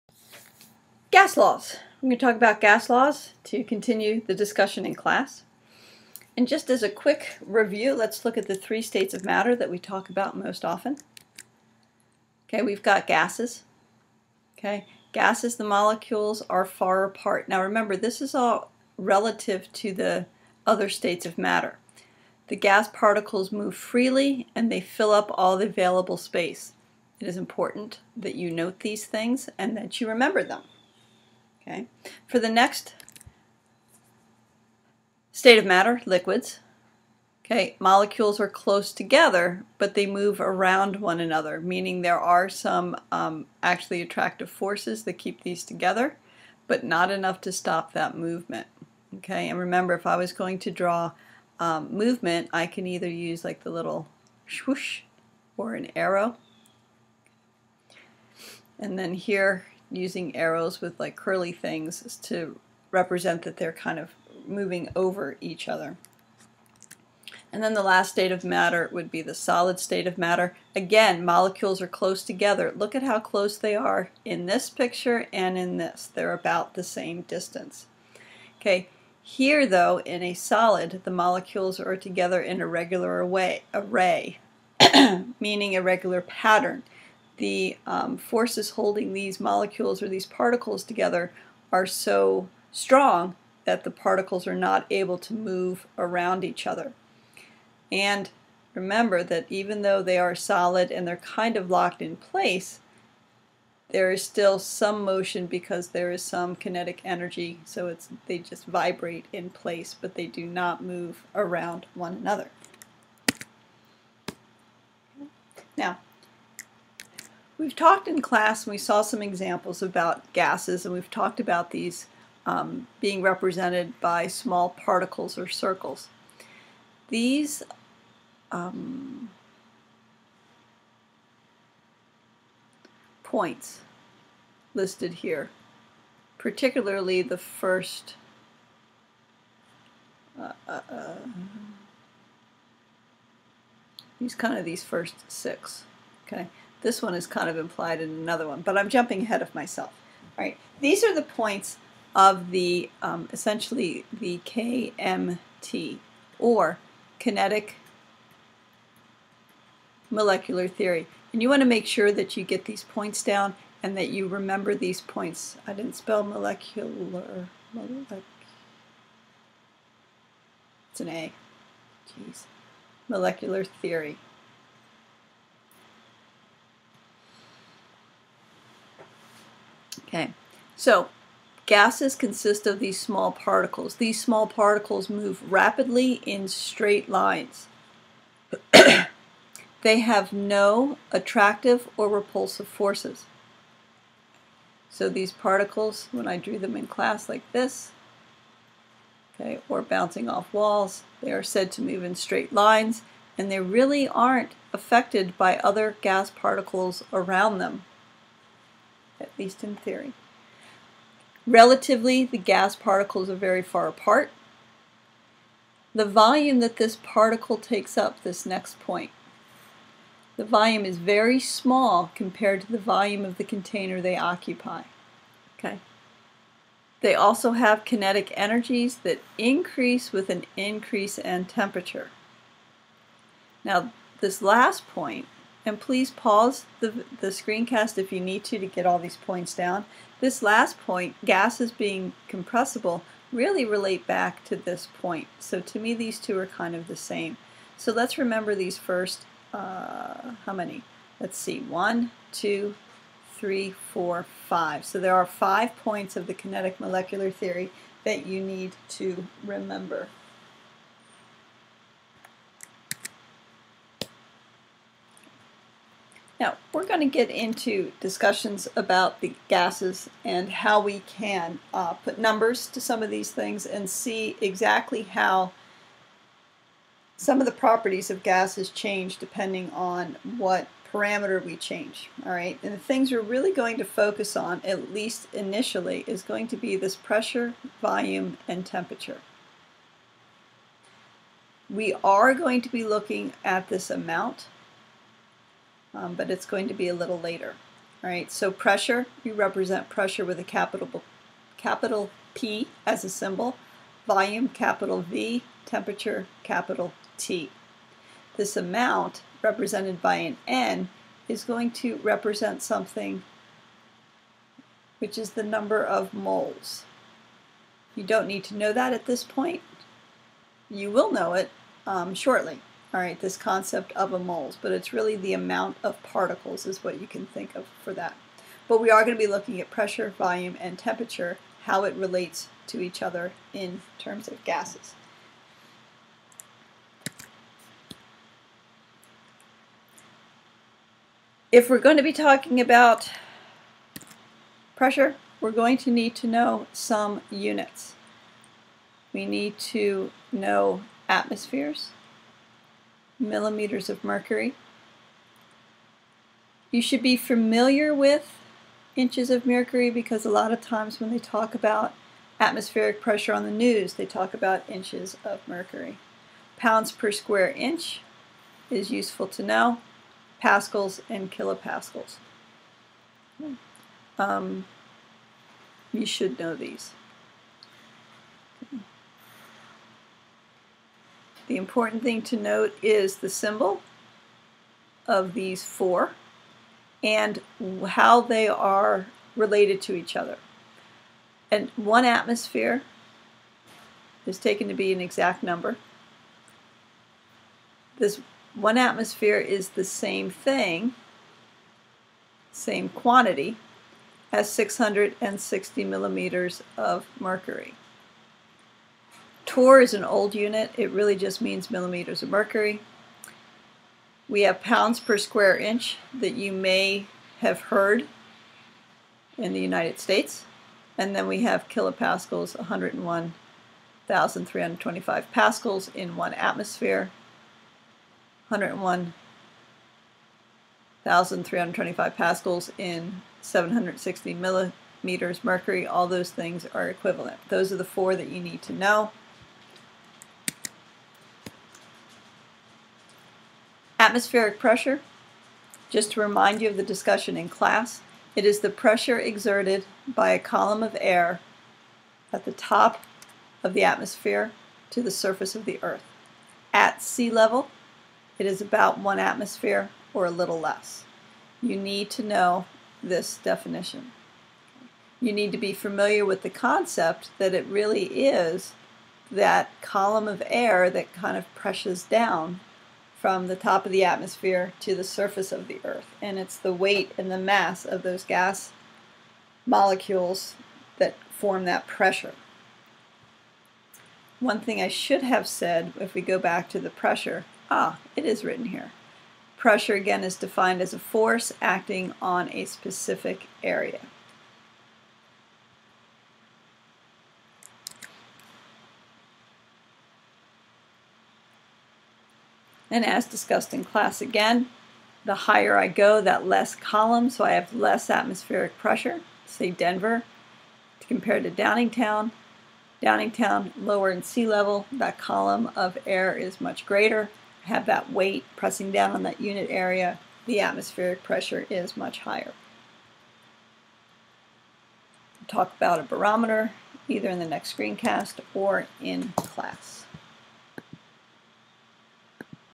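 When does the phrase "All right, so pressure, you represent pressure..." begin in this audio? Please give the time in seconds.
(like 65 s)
298 s.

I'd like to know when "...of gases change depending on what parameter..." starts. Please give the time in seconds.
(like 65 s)
278 s.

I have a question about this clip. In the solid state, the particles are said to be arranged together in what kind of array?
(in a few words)
regular array.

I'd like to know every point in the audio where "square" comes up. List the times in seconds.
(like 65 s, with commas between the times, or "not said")
367 s, 415 s.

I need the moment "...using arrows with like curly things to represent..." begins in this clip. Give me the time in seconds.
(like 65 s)
59 s.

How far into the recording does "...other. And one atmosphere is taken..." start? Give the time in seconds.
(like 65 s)
390 s.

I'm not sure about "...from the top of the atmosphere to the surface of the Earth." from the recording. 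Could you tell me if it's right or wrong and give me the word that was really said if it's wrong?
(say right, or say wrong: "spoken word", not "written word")
right.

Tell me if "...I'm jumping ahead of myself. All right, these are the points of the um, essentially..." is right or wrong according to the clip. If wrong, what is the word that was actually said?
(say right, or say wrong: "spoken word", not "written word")
right.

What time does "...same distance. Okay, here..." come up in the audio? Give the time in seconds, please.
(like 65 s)
76 s.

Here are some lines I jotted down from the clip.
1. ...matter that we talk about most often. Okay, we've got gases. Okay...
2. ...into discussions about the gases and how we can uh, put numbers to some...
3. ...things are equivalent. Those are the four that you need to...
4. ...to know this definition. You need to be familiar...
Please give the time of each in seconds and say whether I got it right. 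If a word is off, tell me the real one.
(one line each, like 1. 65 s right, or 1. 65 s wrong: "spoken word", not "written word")
1. 9 s right
2. 267 s right
3. 436 s right
4. 462 s right.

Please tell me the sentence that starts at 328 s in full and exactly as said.
But we are going to be looking at pressure, volume, and temperature, how it relates to each other in terms of gases.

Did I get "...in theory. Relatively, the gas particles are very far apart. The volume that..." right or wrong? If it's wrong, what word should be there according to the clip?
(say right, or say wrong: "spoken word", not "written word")
right.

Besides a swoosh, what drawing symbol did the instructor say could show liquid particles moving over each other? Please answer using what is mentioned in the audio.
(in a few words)
an arrow.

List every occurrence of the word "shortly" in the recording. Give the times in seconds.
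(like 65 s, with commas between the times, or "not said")
322 s.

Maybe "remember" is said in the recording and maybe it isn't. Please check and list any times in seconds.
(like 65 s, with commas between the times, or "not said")
17 s, 30 s, 49 s, 98 s, 164 s, 248 s, 259 s.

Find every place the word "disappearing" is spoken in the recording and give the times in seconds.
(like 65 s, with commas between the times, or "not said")
not said.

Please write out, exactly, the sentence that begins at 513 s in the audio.
Downingtown, lower in sea level, that column of air is much greater.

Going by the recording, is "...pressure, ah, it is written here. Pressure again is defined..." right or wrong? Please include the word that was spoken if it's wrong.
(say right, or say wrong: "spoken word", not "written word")
right.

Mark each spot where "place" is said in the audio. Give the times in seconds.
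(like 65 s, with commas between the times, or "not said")
102 s, 109 s.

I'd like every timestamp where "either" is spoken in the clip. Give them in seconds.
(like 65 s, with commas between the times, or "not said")
52 s, 527 s.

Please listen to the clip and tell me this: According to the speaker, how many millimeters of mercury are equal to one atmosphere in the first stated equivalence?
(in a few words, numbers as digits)
660.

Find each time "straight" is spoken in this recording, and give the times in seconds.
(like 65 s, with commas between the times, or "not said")
186 s, 202 s.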